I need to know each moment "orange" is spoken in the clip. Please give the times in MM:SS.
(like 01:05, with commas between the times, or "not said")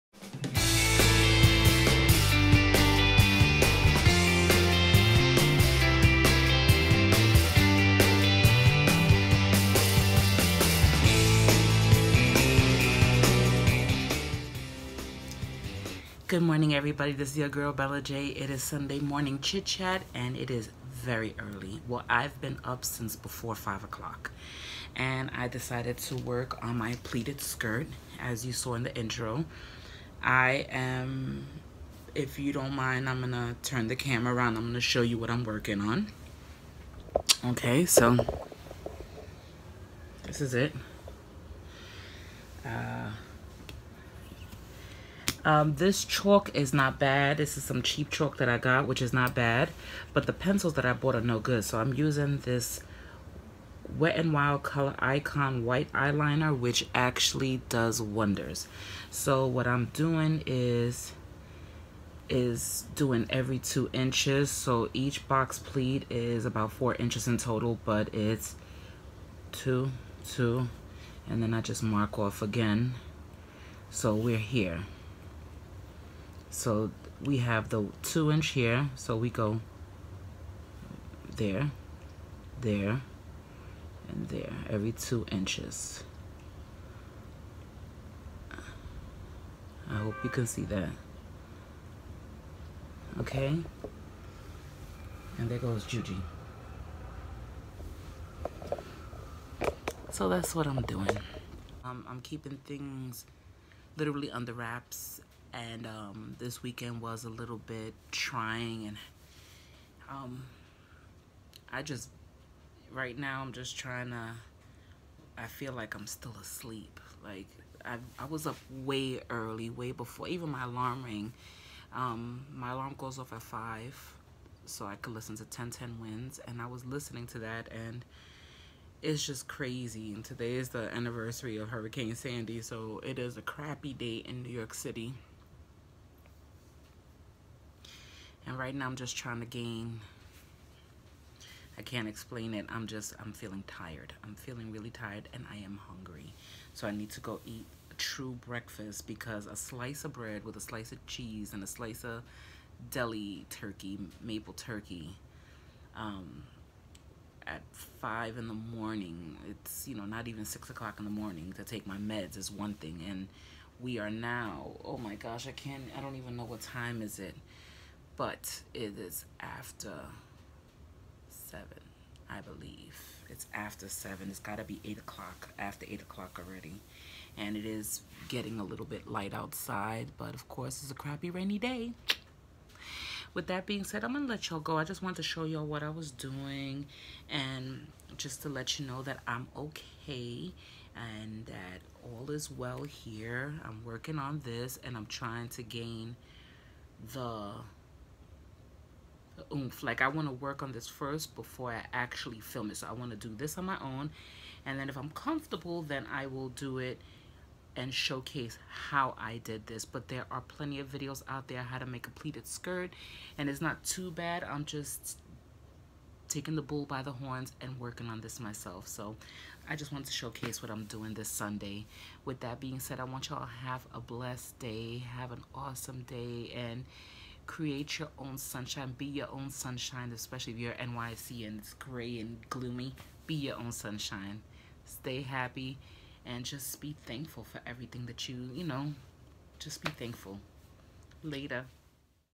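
not said.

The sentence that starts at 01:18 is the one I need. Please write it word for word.
So we go there, there, and there, every two inches.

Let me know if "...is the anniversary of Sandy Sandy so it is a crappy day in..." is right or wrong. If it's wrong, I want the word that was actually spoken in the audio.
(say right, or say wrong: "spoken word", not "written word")
wrong: "Hurricane", not "Sandy".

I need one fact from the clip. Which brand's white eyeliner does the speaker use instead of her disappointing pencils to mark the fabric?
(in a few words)
Wet n Wild.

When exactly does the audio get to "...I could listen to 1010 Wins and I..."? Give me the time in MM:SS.
02:04.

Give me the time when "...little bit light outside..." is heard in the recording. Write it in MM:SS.
02:58.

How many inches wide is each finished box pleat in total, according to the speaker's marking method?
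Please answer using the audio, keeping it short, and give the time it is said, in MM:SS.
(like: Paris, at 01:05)
4, at 01:06.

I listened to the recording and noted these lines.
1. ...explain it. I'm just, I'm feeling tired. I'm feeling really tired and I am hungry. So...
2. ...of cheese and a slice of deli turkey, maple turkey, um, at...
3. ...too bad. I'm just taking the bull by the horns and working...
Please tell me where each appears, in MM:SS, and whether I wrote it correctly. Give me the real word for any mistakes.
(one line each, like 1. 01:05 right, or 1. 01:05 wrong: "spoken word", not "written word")
1. 02:22 right
2. 02:30 right
3. 03:33 right.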